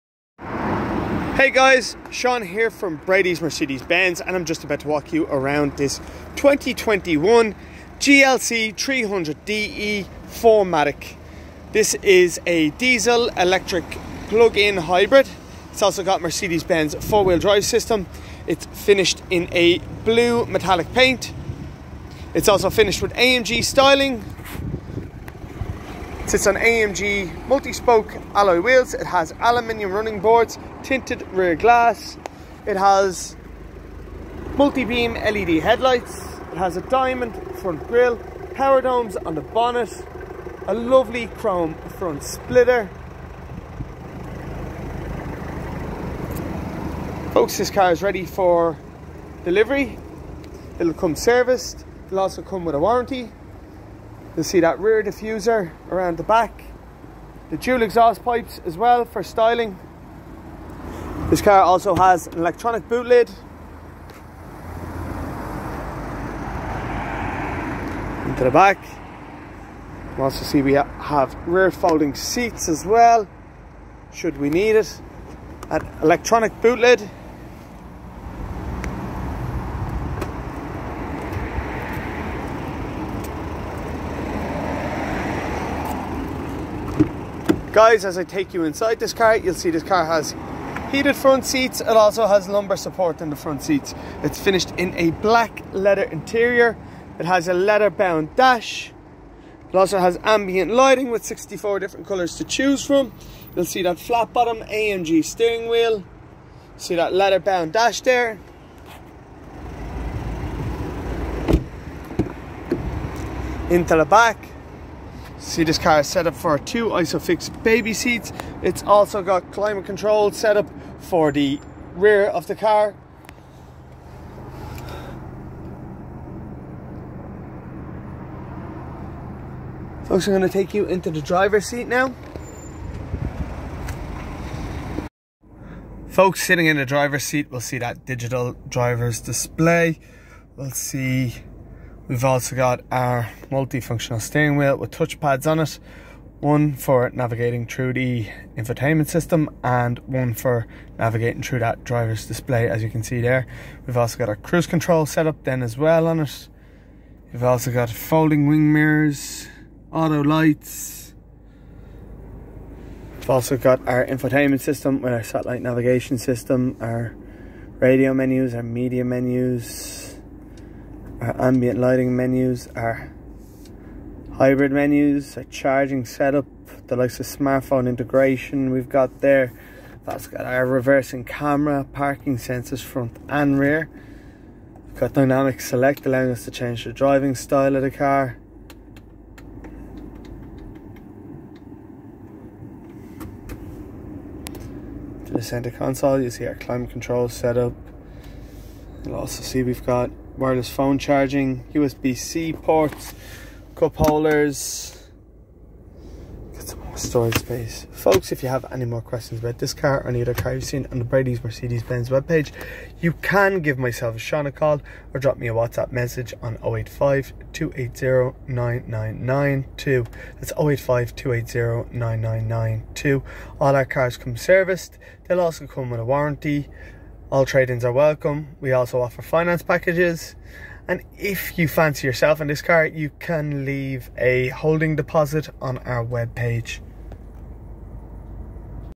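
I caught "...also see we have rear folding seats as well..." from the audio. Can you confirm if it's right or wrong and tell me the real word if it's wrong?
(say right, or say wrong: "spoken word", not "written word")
right.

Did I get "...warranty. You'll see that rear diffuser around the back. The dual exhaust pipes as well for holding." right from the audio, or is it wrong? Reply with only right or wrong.
wrong.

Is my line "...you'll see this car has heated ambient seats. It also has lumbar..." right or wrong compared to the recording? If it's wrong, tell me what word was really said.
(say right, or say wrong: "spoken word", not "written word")
wrong: "front", not "ambient".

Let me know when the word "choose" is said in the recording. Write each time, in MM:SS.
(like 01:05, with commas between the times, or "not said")
01:42.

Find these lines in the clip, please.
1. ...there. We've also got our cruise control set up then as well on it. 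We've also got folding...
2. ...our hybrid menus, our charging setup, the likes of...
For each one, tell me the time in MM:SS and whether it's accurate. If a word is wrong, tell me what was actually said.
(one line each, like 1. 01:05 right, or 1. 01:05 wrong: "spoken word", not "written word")
1. 02:33 right
2. 02:52 right.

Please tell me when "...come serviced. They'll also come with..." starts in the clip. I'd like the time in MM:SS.
03:44.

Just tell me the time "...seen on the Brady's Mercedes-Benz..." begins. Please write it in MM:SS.
03:30.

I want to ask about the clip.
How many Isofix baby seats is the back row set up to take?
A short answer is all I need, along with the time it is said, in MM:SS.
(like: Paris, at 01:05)
2, at 01:56.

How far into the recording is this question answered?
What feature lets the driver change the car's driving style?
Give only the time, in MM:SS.
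03:05.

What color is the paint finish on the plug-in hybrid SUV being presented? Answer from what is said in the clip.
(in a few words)
Blue metallic.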